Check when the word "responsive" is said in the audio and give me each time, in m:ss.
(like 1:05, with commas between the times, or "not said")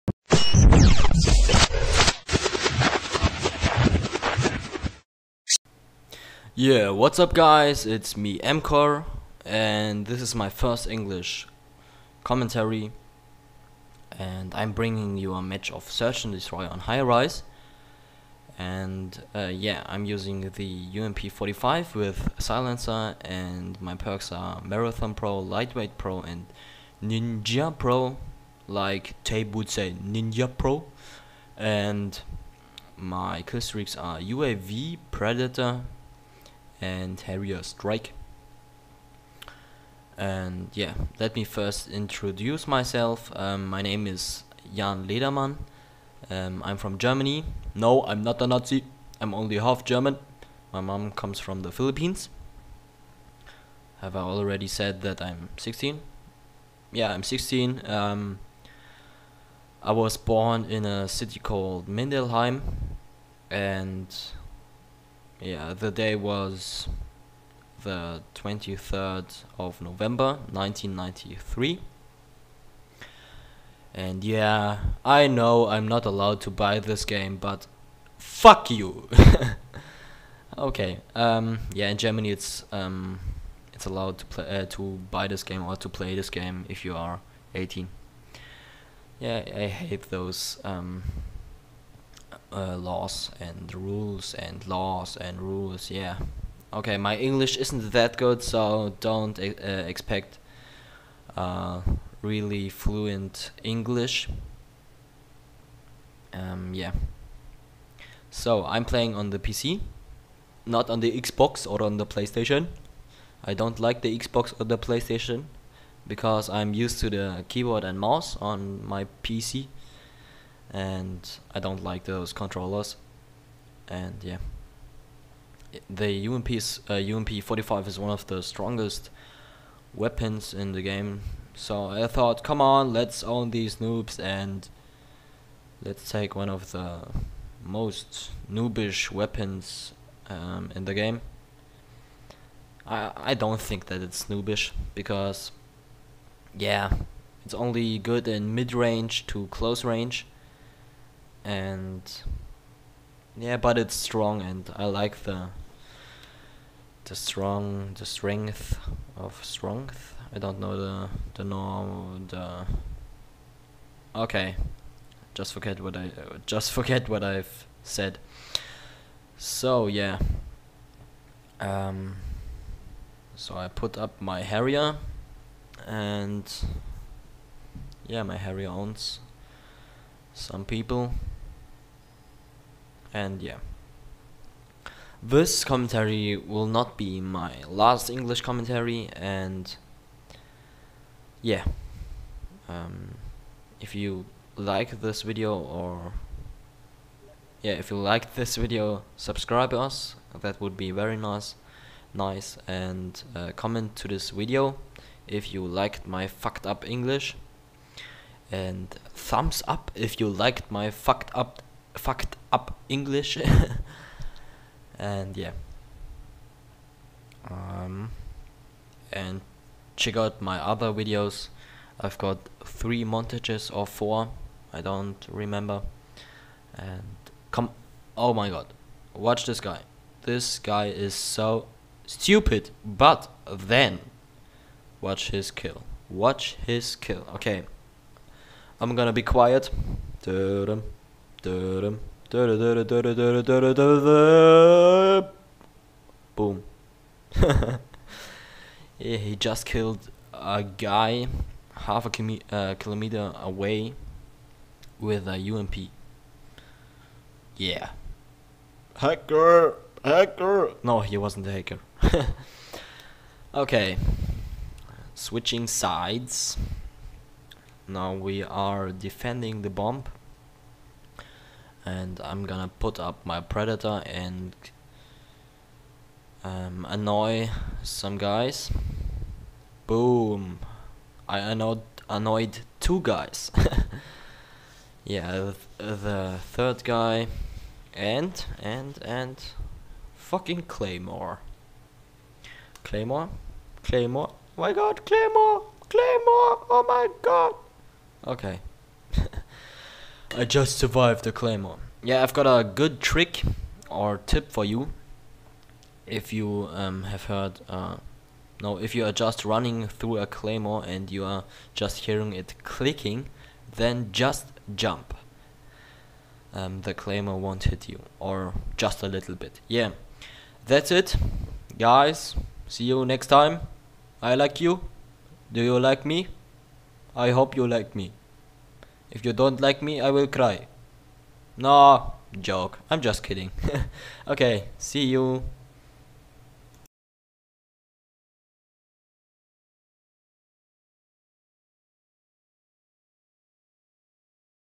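not said.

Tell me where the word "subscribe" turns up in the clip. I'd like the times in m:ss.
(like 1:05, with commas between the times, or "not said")
3:19.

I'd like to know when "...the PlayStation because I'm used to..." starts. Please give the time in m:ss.
1:54.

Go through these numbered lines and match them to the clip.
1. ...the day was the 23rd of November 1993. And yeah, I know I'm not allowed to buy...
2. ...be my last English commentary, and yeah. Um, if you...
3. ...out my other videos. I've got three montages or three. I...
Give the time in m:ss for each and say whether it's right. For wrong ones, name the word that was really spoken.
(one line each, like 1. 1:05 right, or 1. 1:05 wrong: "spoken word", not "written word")
1. 1:05 right
2. 3:06 right
3. 3:40 wrong: "four", not "three".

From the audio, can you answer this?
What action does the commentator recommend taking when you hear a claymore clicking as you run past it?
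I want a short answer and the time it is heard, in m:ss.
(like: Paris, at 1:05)
Jump, at 5:14.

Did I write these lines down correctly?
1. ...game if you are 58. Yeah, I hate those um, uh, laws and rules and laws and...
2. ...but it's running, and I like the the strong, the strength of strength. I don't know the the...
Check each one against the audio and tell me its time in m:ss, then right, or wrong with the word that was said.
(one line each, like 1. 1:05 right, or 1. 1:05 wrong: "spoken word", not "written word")
1. 1:26 wrong: "18", not "58"
2. 2:33 wrong: "strong", not "running".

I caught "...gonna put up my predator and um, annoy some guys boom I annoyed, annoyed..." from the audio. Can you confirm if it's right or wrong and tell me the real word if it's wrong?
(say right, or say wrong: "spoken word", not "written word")
right.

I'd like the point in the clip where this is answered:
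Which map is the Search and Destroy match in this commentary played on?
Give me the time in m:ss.
0:16.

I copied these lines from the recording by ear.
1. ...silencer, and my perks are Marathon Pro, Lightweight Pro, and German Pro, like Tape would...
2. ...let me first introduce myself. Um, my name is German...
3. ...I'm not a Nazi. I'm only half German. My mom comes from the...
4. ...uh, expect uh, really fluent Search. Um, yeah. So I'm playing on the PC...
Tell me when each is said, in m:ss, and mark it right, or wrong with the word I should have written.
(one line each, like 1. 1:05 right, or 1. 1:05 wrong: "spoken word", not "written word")
1. 0:22 wrong: "Ninja", not "German"
2. 0:41 wrong: "Jan", not "German"
3. 0:48 right
4. 1:39 wrong: "English", not "Search".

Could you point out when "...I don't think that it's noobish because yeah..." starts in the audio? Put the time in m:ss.
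2:23.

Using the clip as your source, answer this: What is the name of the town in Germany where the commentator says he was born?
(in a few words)
Mindelheim.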